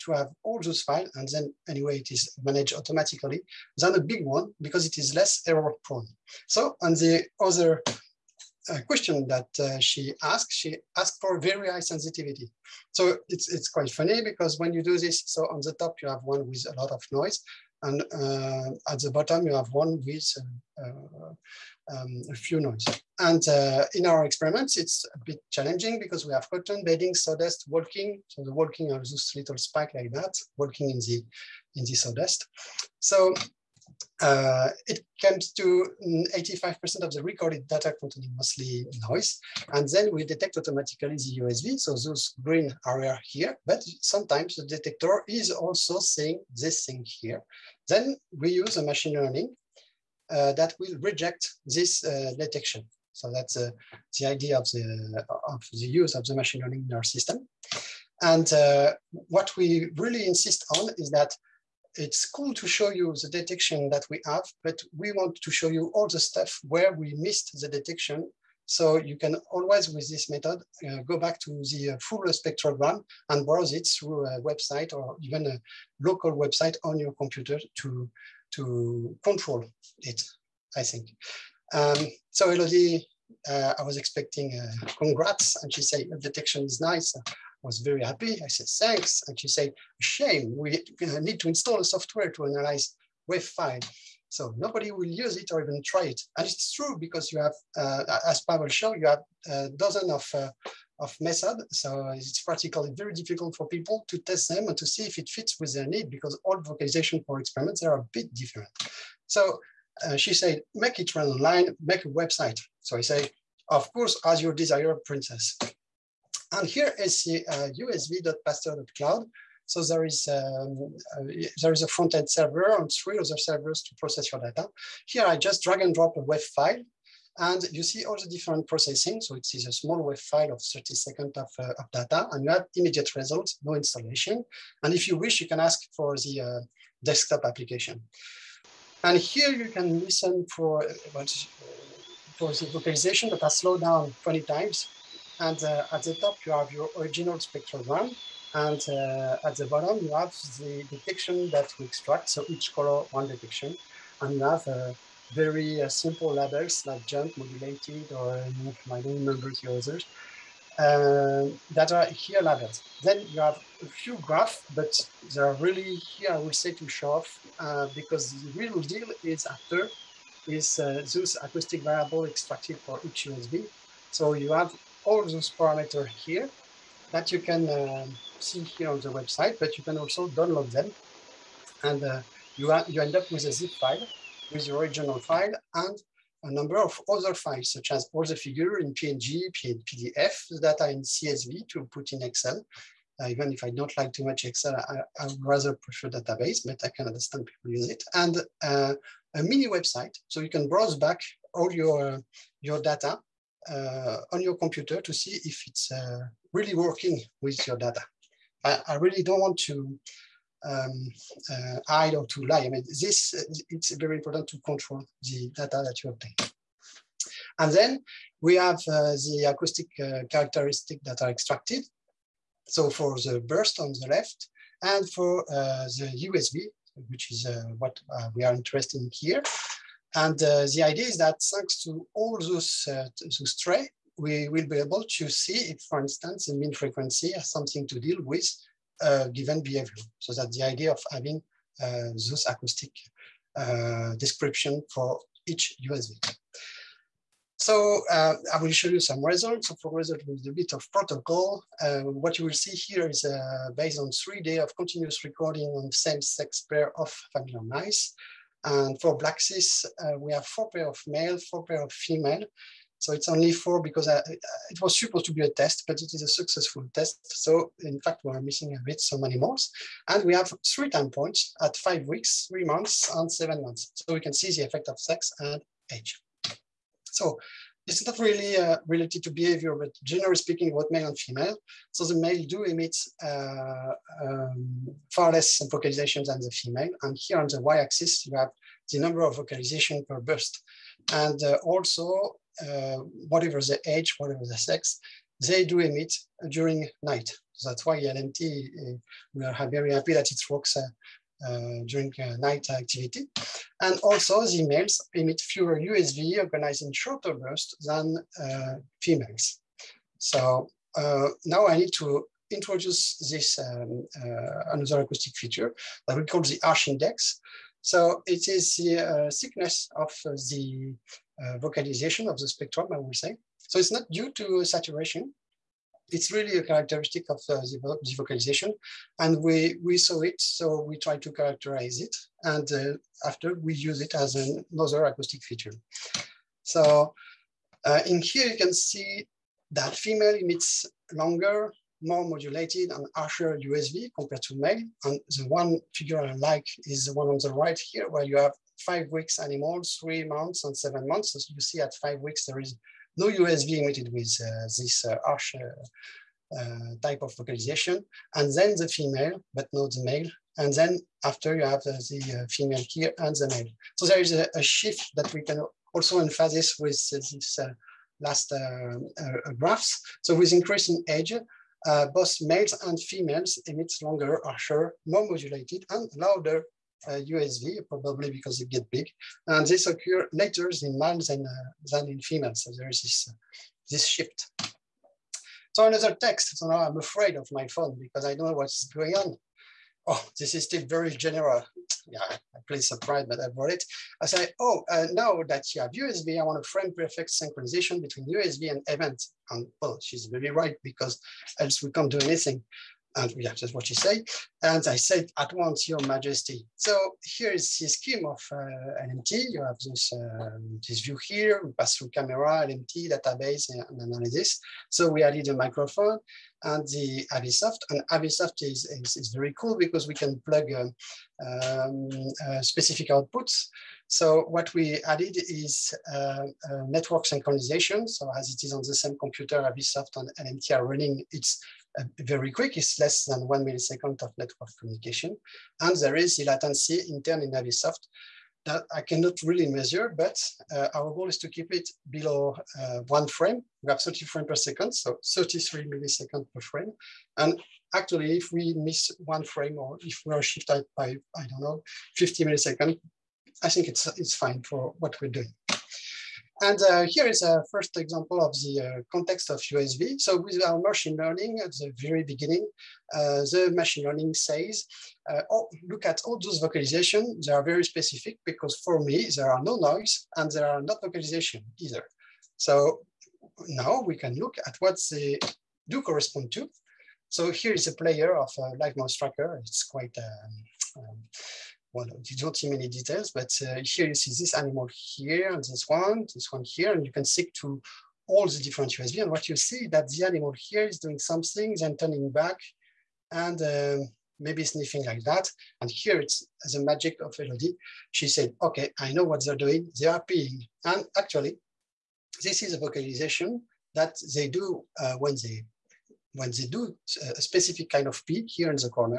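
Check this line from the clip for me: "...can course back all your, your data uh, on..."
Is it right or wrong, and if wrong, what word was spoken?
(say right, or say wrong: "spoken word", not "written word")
wrong: "browse", not "course".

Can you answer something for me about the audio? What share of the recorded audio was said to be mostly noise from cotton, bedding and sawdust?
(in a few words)
85%.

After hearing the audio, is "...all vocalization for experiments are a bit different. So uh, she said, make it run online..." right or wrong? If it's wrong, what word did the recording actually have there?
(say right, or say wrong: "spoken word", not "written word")
right.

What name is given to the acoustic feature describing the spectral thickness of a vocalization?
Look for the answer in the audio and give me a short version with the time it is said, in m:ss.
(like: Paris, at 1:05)
harsh index, at 5:16.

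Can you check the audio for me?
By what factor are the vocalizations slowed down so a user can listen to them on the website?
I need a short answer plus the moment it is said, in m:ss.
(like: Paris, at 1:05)
20 times, at 2:24.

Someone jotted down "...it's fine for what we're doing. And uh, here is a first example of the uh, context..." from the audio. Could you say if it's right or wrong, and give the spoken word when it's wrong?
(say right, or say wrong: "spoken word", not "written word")
right.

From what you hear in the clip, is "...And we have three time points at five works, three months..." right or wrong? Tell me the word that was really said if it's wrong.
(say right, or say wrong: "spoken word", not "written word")
wrong: "weeks", not "works".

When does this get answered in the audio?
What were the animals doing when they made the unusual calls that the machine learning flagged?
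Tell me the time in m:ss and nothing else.
8:20.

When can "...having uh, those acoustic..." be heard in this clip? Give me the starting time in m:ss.
4:01.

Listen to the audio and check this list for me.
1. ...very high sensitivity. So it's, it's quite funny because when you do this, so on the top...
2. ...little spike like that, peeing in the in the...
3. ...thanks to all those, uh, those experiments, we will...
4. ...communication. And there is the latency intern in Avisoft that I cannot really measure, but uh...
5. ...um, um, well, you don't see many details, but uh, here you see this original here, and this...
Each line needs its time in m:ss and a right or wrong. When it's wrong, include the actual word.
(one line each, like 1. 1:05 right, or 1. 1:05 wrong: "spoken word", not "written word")
1. 0:11 right
2. 0:29 wrong: "walking", not "peeing"
3. 3:51 wrong: "traits", not "experiments"
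4. 7:14 right
5. 8:00 wrong: "animal", not "original".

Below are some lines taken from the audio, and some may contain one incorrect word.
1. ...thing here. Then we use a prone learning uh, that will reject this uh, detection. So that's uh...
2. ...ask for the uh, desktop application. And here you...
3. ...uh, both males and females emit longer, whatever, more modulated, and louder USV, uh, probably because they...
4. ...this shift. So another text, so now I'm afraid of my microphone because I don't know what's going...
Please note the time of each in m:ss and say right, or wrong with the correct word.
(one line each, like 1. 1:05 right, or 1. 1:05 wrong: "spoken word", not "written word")
1. 0:46 wrong: "machine", not "prone"
2. 2:15 right
3. 6:11 wrong: "harsher", not "whatever"
4. 6:23 wrong: "phone", not "microphone".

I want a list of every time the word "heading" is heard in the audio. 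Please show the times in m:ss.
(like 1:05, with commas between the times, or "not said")
not said.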